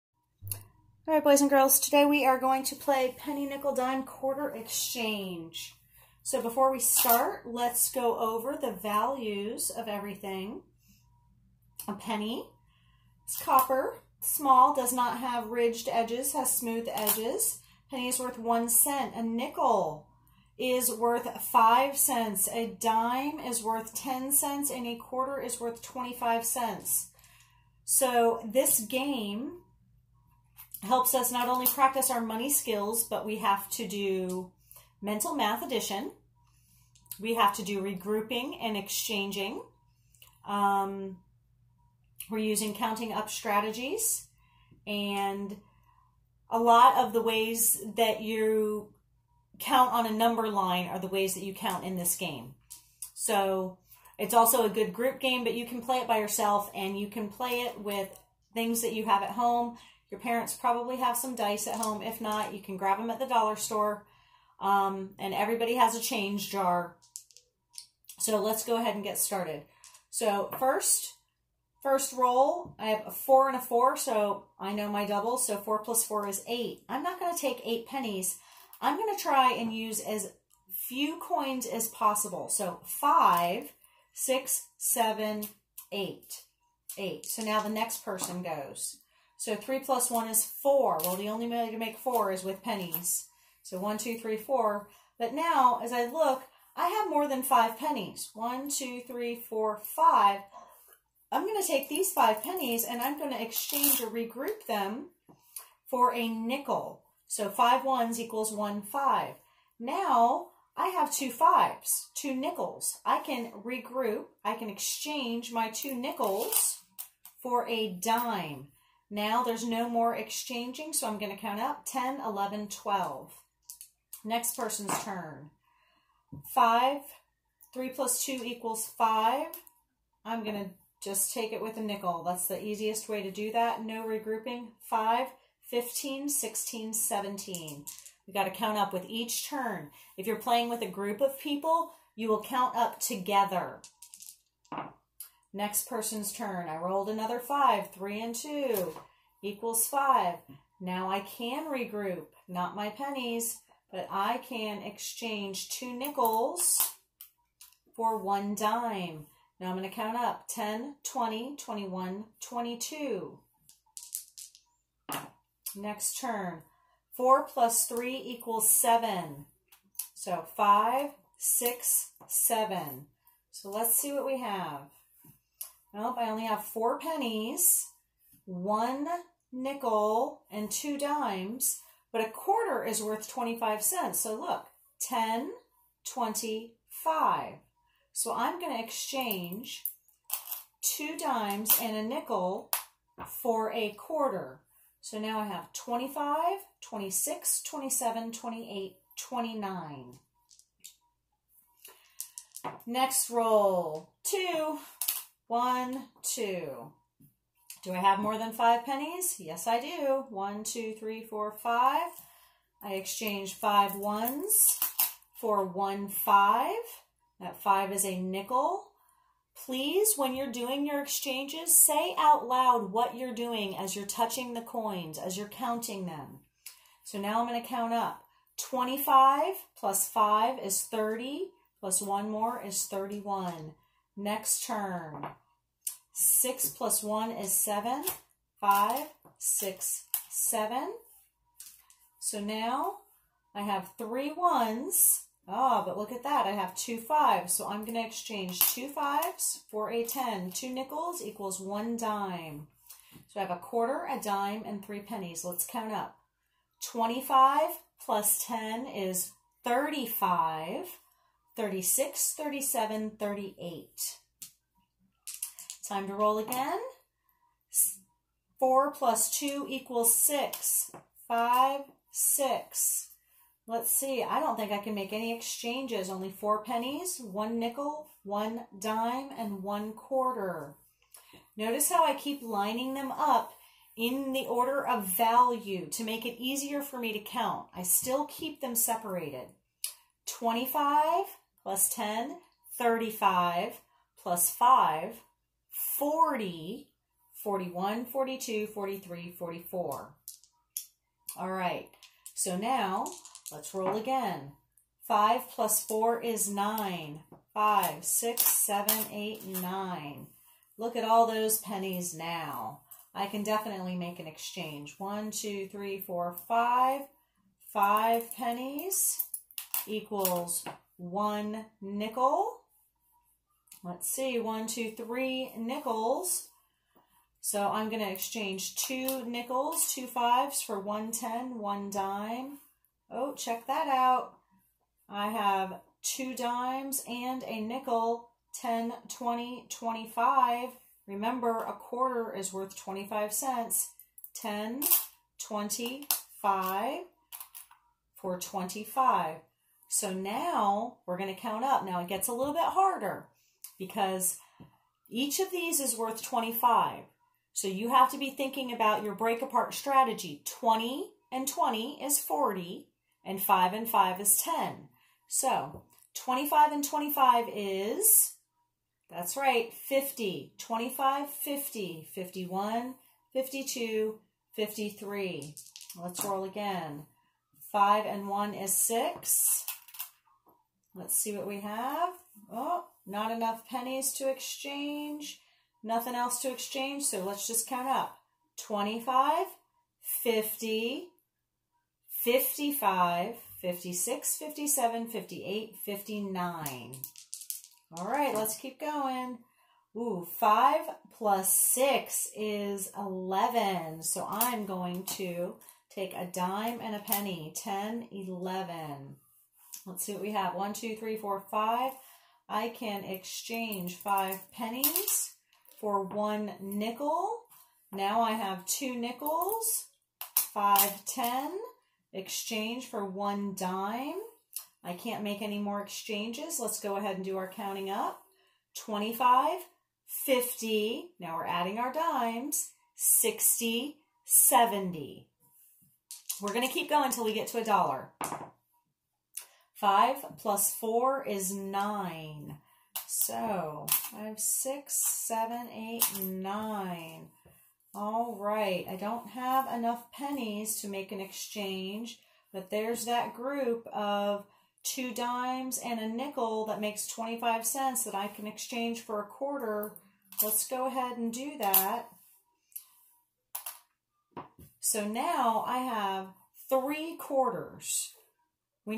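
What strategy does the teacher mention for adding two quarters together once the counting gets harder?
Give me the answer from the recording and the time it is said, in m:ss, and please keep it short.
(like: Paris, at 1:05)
break apart strategy, at 5:59.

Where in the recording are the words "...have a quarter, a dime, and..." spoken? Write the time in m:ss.
4:13.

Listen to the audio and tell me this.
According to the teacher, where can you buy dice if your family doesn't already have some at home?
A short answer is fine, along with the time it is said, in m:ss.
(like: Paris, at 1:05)
the dollar store, at 1:03.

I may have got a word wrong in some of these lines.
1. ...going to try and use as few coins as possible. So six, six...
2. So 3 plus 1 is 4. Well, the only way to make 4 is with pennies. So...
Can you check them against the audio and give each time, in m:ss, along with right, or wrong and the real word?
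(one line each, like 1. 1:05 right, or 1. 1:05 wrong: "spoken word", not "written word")
1. 1:18 wrong: "five", not "six"
2. 1:29 right.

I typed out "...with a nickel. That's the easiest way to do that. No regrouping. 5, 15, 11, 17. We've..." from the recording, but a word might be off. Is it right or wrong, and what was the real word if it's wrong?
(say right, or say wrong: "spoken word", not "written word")
wrong: "16", not "11".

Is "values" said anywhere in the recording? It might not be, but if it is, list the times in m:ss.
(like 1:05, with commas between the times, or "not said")
0:08, 4:45.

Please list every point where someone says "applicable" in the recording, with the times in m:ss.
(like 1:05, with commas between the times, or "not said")
not said.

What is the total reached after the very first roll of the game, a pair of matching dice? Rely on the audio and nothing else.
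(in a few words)
8.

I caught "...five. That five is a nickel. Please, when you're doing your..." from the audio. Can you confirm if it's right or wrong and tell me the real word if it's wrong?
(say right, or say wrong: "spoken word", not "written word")
right.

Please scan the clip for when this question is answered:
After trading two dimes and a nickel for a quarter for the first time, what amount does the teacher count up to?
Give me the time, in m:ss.
3:15.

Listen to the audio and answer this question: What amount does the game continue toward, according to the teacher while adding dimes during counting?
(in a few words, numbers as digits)
a dollar.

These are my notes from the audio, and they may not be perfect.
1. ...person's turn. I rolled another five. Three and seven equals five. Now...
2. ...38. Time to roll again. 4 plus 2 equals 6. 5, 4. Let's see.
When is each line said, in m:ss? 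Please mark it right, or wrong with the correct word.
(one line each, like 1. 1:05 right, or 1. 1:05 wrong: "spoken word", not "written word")
1. 2:25 wrong: "two", not "seven"
2. 4:23 wrong: "6", not "4".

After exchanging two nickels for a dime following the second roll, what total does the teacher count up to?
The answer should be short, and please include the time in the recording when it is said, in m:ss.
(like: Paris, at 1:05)
12, at 2:01.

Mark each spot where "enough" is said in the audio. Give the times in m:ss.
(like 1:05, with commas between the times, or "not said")
6:23, 7:29.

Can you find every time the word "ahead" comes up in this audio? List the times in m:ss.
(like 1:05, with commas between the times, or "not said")
1:08, 7:06, 7:40.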